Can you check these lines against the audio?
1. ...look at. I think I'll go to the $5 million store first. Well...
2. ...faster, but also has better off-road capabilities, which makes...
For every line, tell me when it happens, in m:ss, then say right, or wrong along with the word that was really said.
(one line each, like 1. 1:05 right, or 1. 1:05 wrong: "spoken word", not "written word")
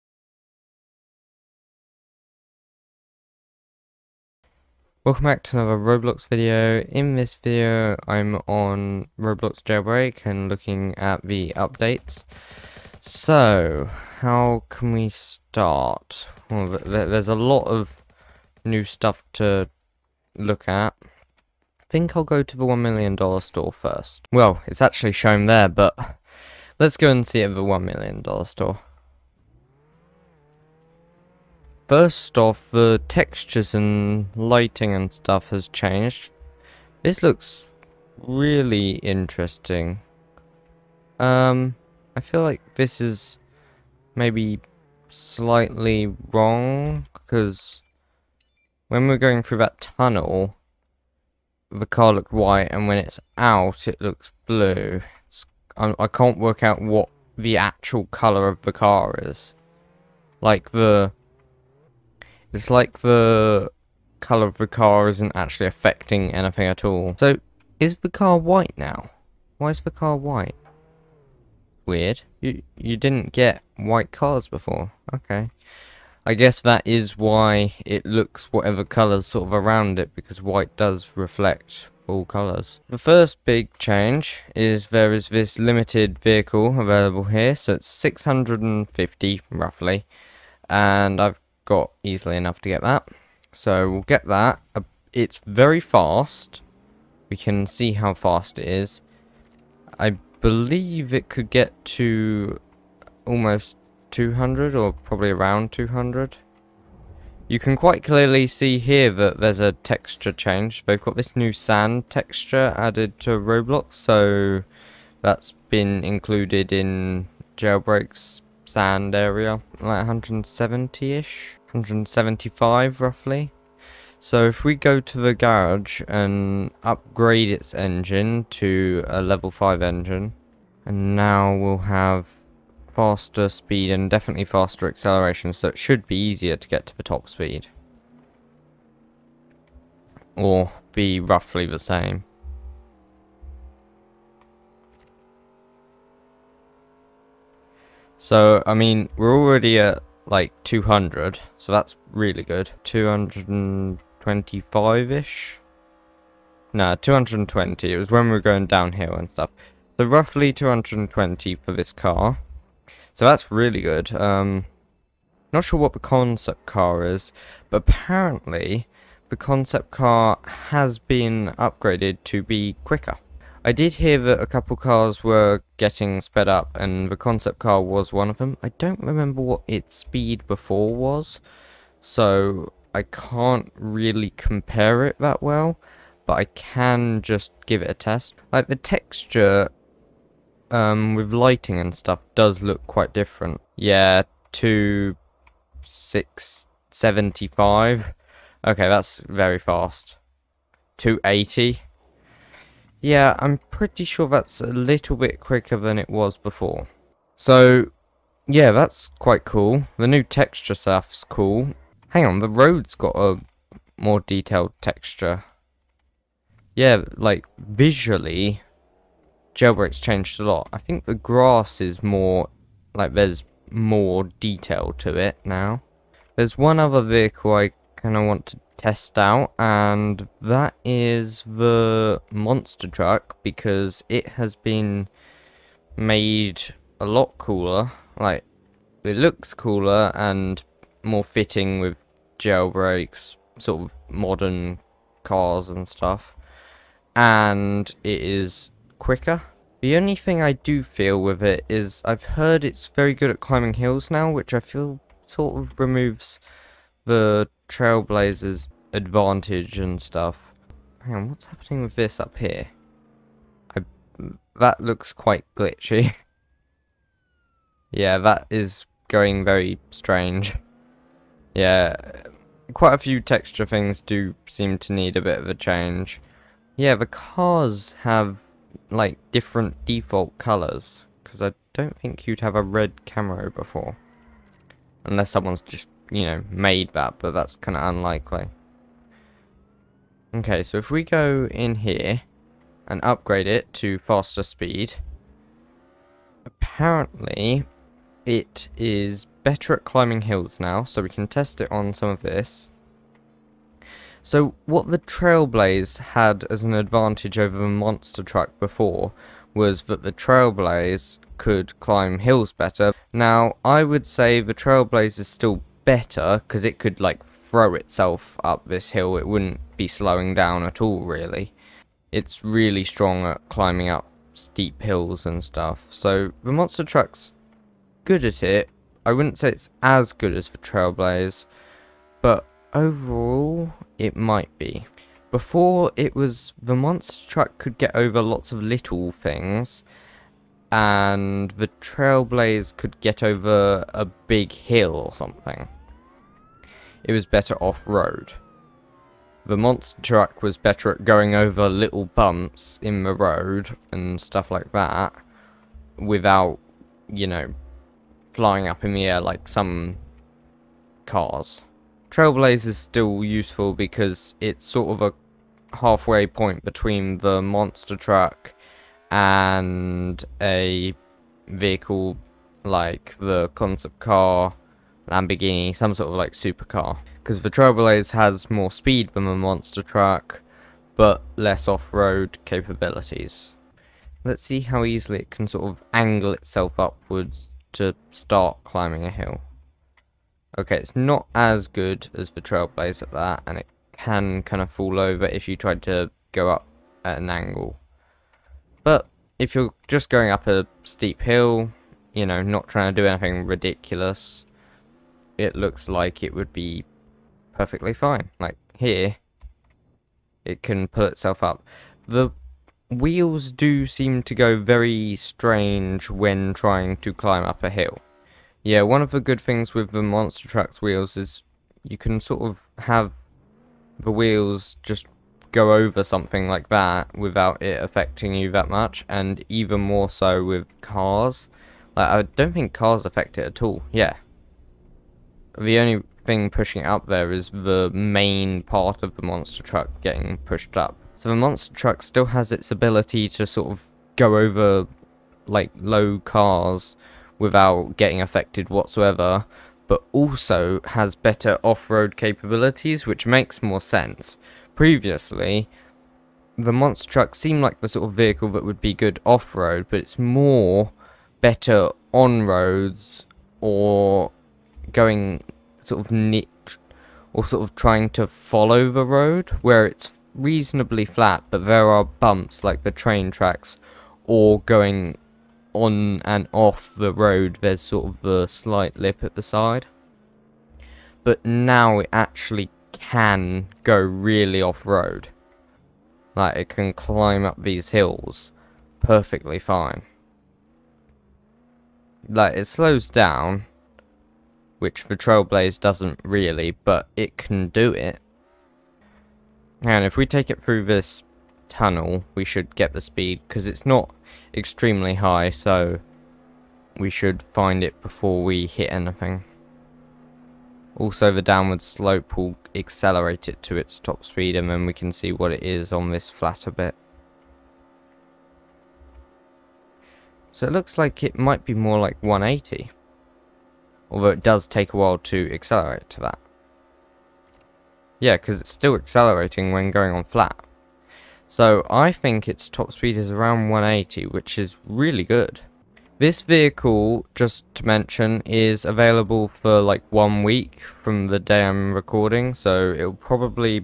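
1. 0:20 wrong: "1", not "5"
2. 7:28 wrong: "whatsoever", not "faster".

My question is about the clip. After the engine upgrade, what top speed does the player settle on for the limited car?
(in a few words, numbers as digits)
220.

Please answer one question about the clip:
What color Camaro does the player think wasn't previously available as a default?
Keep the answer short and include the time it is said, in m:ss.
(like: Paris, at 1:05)
Red, at 4:42.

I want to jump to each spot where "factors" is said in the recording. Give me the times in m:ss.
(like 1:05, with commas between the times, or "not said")
not said.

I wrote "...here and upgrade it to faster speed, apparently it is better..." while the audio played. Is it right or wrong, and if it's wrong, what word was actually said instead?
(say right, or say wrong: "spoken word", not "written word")
right.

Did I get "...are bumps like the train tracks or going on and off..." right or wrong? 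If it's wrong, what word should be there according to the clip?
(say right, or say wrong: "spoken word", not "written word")
right.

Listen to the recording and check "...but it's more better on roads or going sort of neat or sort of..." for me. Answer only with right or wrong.
right.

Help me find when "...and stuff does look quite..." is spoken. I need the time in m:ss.
3:11.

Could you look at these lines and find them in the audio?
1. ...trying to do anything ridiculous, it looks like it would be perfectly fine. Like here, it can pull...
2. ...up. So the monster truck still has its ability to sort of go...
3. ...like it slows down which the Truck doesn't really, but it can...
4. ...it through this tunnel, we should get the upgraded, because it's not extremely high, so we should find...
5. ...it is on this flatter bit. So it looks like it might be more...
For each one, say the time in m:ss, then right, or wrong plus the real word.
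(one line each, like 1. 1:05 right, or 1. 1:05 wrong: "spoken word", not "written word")
1. 6:42 right
2. 7:20 right
3. 8:12 wrong: "Trailblaze", not "Truck"
4. 8:20 wrong: "speed", not "upgraded"
5. 8:35 right.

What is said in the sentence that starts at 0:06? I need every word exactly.
In this video, I'm on Roblox Jailbreak and looking at the updates.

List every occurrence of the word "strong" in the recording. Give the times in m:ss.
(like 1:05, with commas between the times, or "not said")
5:22.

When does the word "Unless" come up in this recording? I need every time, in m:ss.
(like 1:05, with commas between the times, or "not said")
4:45.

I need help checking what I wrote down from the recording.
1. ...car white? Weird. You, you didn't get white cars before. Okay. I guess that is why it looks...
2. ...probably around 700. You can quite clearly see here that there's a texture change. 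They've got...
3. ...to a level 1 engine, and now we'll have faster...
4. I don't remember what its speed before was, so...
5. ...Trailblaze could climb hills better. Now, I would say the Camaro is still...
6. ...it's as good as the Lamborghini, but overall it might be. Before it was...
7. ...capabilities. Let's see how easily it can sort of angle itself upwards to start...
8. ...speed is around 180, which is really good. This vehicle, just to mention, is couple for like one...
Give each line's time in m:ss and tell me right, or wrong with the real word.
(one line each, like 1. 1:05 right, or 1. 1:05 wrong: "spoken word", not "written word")
1. 1:09 right
2. 1:44 wrong: "200", not "700"
3. 2:08 wrong: "5", not "1"
4. 2:58 right
5. 5:10 wrong: "Trailblaze", not "Camaro"
6. 5:29 wrong: "Trailblaze", not "Lamborghini"
7. 6:22 right
8. 8:52 wrong: "available", not "couple".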